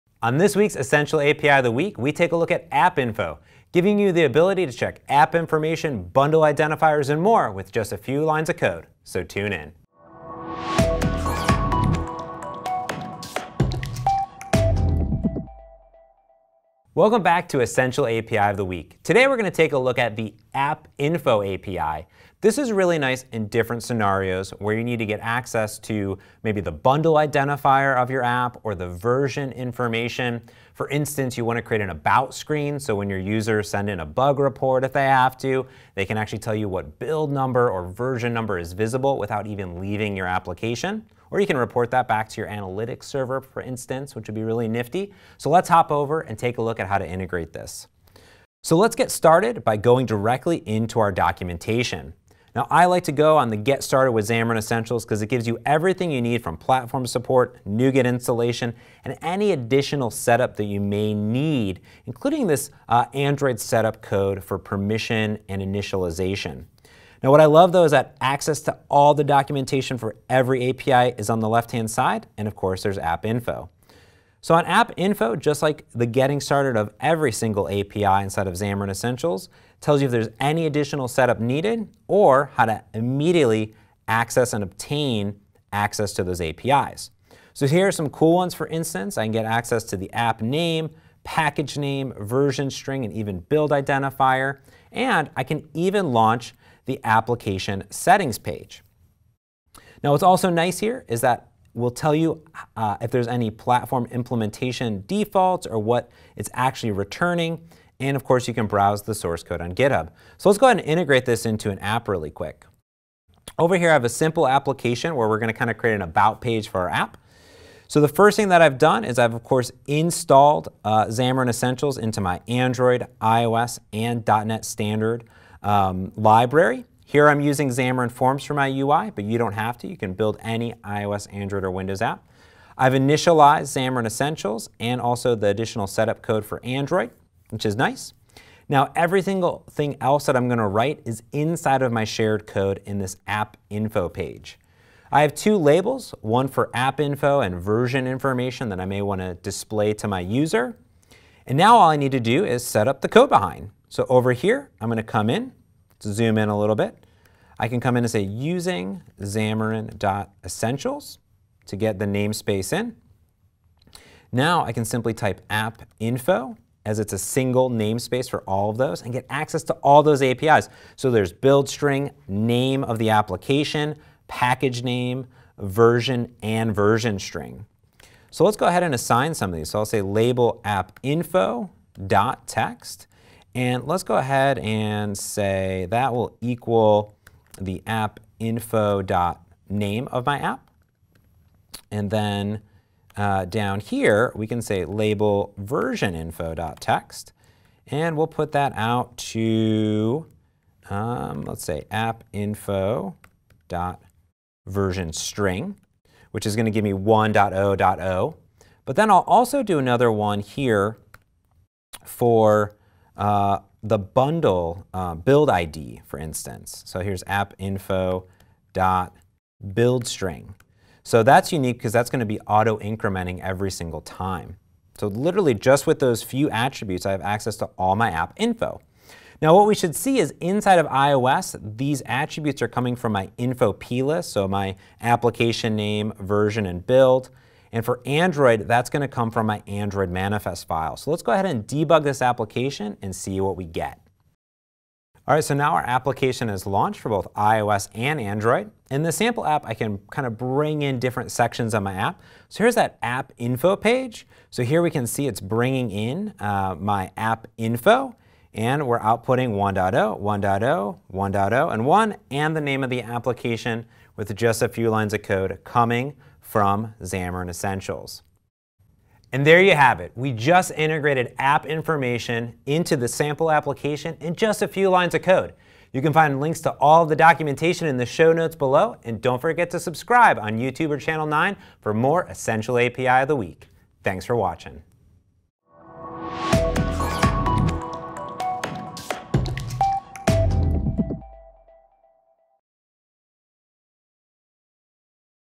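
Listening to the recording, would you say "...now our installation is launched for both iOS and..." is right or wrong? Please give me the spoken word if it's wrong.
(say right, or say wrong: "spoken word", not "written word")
wrong: "application", not "installation".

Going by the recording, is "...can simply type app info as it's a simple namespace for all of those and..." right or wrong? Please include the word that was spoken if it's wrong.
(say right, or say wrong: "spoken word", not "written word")
wrong: "single", not "simple".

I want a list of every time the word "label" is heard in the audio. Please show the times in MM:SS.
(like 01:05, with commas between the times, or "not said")
02:25, 03:00, 03:14.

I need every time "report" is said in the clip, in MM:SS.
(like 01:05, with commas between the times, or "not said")
00:34, 00:41.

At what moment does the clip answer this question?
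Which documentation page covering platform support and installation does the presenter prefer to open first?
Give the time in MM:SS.
00:53.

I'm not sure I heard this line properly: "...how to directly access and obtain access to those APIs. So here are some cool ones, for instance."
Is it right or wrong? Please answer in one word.
wrong.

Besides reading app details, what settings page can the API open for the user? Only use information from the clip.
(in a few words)
application settings page.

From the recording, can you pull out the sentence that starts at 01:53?
Over here, I have a simple application where we're going to kind of create an about page for our app.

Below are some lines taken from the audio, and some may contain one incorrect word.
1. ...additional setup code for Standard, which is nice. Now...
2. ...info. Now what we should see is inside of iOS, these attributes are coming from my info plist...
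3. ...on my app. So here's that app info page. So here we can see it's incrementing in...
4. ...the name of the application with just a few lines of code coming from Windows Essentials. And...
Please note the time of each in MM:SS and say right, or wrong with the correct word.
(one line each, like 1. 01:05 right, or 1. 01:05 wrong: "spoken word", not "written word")
1. 02:15 wrong: "Android", not "Standard"
2. 03:48 right
3. 04:11 wrong: "bringing", not "incrementing"
4. 04:22 wrong: "Xamarin", not "Windows".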